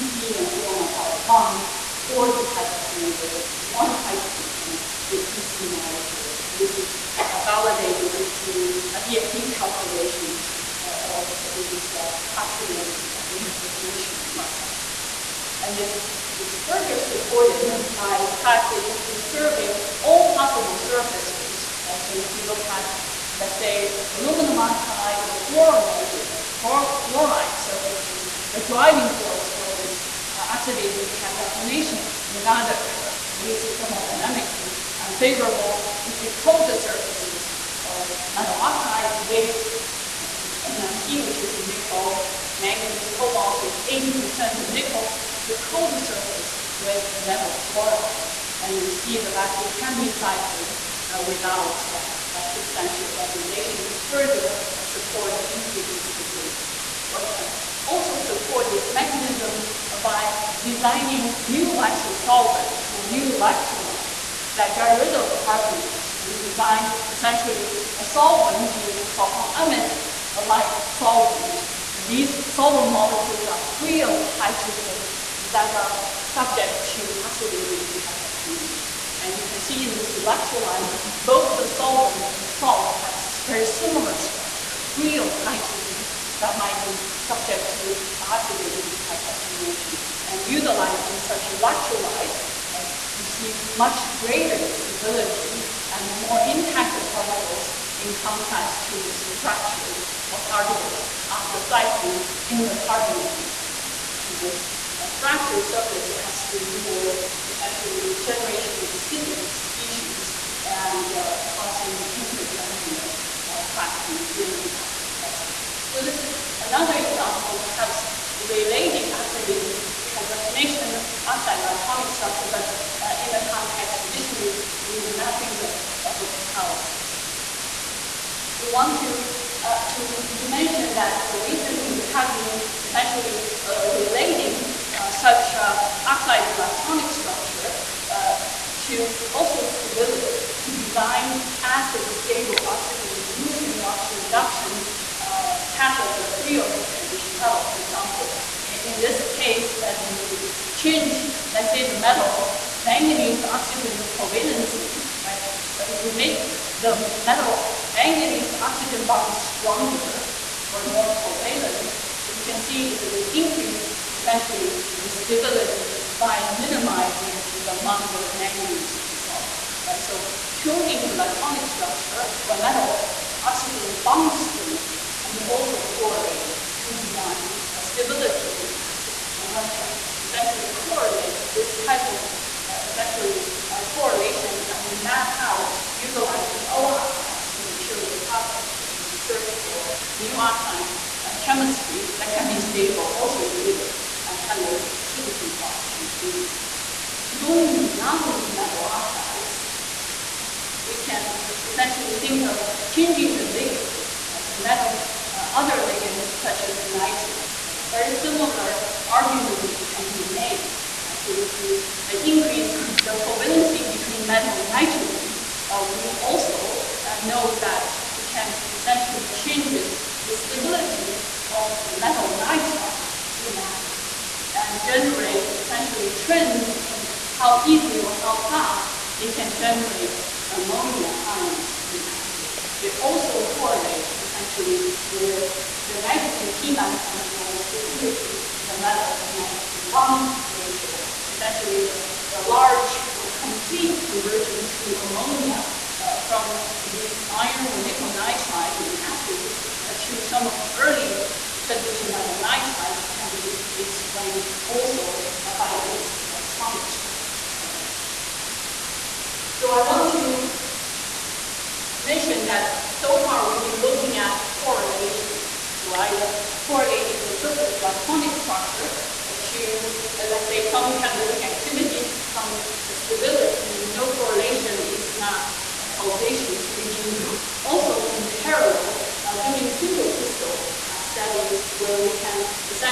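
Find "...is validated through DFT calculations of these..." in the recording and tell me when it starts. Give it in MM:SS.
00:06.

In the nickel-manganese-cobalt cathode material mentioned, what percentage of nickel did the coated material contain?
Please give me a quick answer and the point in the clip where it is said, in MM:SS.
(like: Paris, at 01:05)
80%, at 00:43.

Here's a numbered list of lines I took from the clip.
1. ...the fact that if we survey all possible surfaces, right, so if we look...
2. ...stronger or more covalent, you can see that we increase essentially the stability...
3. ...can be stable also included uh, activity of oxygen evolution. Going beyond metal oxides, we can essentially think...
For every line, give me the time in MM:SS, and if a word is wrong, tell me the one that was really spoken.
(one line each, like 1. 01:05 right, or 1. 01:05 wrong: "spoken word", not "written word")
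1. 00:18 right
2. 02:39 right
3. 03:12 right.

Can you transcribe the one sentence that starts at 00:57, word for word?
One can also support this mechanism by designing new electrosolvent or new electrolyte that got rid of carbonate.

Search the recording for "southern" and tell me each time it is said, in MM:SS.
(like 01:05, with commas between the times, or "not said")
not said.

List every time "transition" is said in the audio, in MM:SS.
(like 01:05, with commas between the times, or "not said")
02:26, 04:11.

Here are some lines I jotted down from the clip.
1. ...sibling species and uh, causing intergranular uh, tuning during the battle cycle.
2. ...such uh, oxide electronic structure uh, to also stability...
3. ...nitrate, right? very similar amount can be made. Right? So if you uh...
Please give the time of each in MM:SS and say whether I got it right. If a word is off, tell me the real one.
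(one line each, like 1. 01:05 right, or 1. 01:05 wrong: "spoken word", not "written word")
1. 01:48 wrong: "cracking", not "tuning"
2. 02:15 right
3. 03:26 wrong: "argument", not "amount".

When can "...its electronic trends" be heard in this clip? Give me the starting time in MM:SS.
04:15.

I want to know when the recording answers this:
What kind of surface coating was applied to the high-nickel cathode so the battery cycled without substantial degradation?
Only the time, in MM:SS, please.
00:47.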